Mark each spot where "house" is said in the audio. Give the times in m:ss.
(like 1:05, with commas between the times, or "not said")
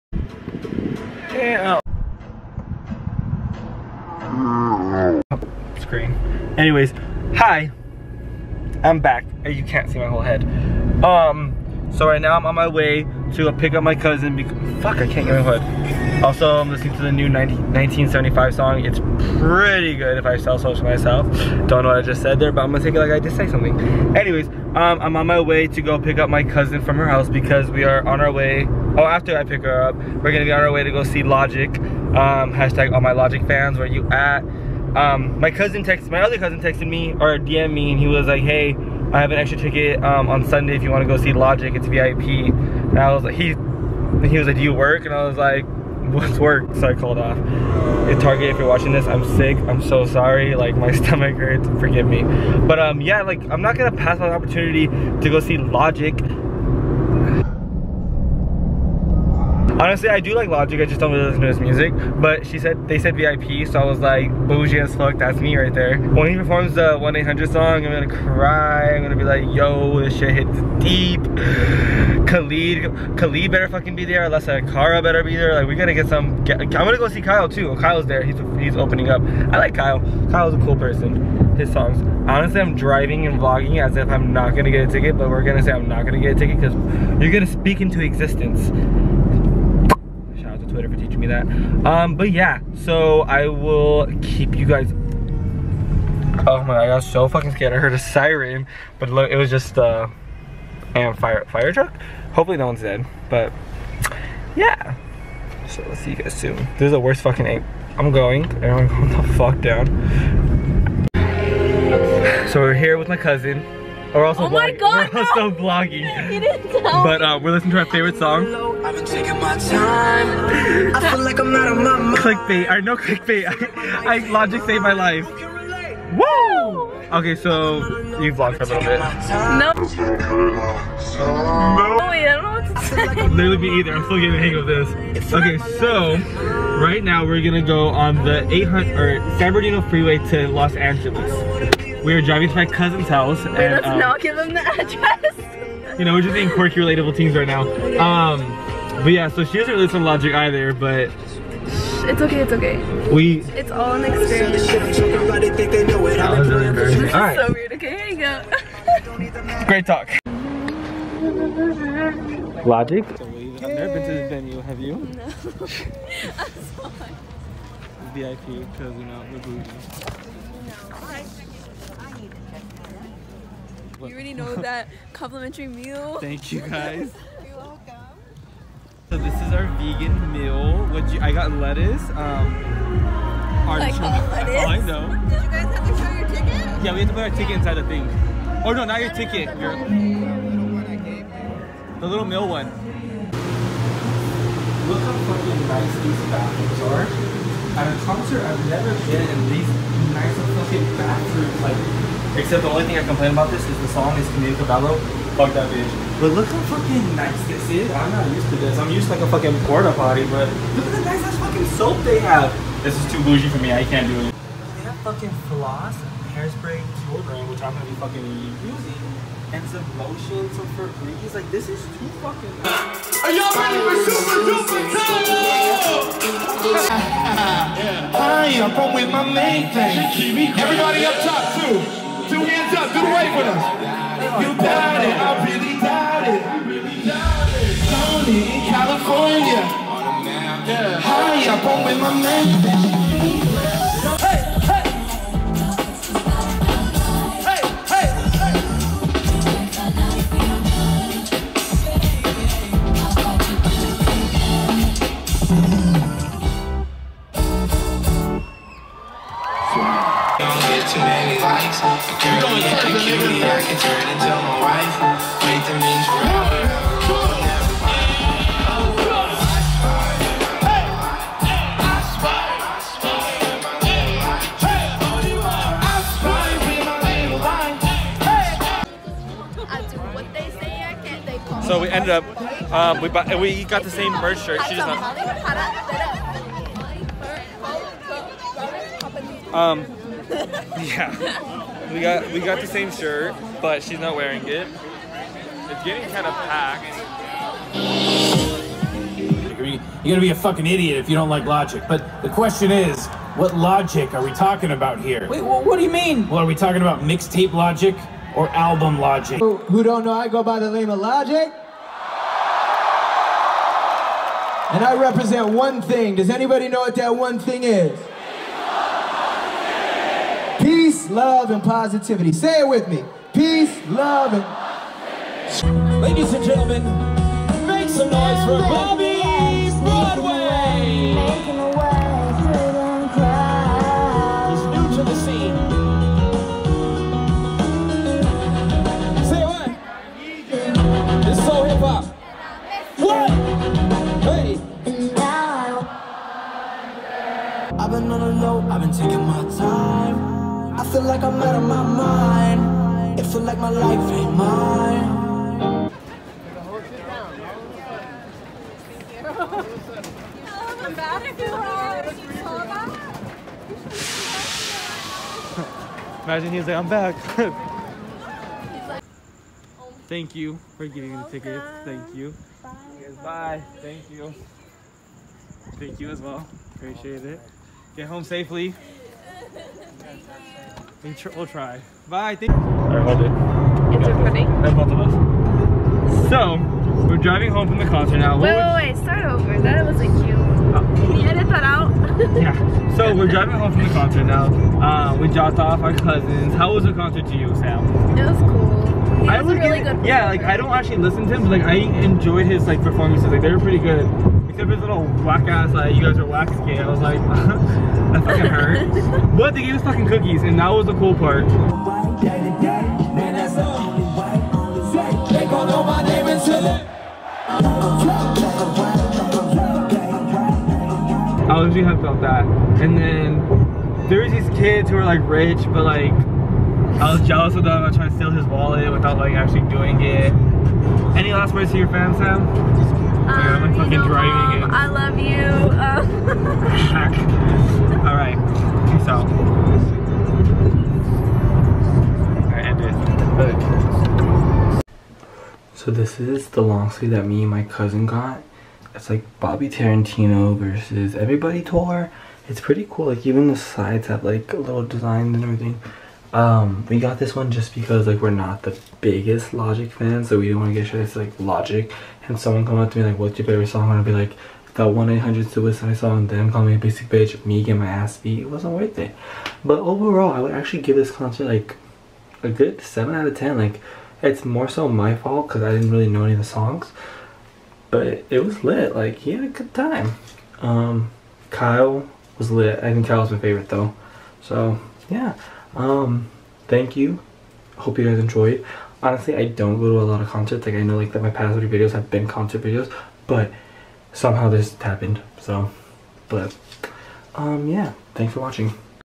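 0:27, 2:23.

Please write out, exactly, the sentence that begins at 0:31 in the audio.
Um, hashtag all my Logic fans, where you at?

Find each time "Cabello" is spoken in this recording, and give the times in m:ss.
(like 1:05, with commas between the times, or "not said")
3:24.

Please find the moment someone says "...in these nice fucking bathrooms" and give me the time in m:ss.
3:19.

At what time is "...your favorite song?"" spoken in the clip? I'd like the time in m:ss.
7:43.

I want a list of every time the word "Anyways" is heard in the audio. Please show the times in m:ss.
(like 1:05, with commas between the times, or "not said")
0:06, 0:24.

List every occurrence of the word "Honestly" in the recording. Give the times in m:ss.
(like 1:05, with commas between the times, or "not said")
0:59, 1:22, 8:09.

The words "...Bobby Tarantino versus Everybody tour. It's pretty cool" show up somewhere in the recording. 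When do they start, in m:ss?
7:29.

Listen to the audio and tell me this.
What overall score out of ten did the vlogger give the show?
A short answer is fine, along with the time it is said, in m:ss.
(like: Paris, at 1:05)
7, at 7:52.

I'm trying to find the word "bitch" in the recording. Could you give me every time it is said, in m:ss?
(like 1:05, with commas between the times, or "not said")
3:25, 7:47.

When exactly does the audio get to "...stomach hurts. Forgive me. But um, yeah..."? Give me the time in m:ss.
0:50.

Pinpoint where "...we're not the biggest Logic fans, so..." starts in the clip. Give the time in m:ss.
7:38.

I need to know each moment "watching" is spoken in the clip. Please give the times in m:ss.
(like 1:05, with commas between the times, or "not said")
0:48, 8:18.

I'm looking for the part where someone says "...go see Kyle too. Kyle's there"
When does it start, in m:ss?
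1:16.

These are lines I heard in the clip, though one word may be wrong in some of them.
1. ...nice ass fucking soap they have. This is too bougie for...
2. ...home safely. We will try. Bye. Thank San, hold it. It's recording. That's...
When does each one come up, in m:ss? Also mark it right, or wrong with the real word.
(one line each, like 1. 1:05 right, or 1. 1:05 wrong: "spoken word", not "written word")
1. 3:31 right
2. 6:18 wrong: "Alright", not "San".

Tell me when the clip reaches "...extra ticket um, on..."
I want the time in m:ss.
0:39.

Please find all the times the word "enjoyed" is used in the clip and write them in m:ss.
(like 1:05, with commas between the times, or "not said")
6:41, 8:08.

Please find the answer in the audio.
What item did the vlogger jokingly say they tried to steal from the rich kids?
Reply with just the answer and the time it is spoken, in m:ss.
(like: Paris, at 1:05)
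wallet, at 7:08.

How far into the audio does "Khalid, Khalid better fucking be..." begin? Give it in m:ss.
1:12.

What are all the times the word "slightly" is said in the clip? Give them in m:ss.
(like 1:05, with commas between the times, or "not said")
not said.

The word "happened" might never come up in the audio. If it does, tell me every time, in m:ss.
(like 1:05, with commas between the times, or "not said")
8:14.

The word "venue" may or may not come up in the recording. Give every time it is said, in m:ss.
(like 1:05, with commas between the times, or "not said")
2:44.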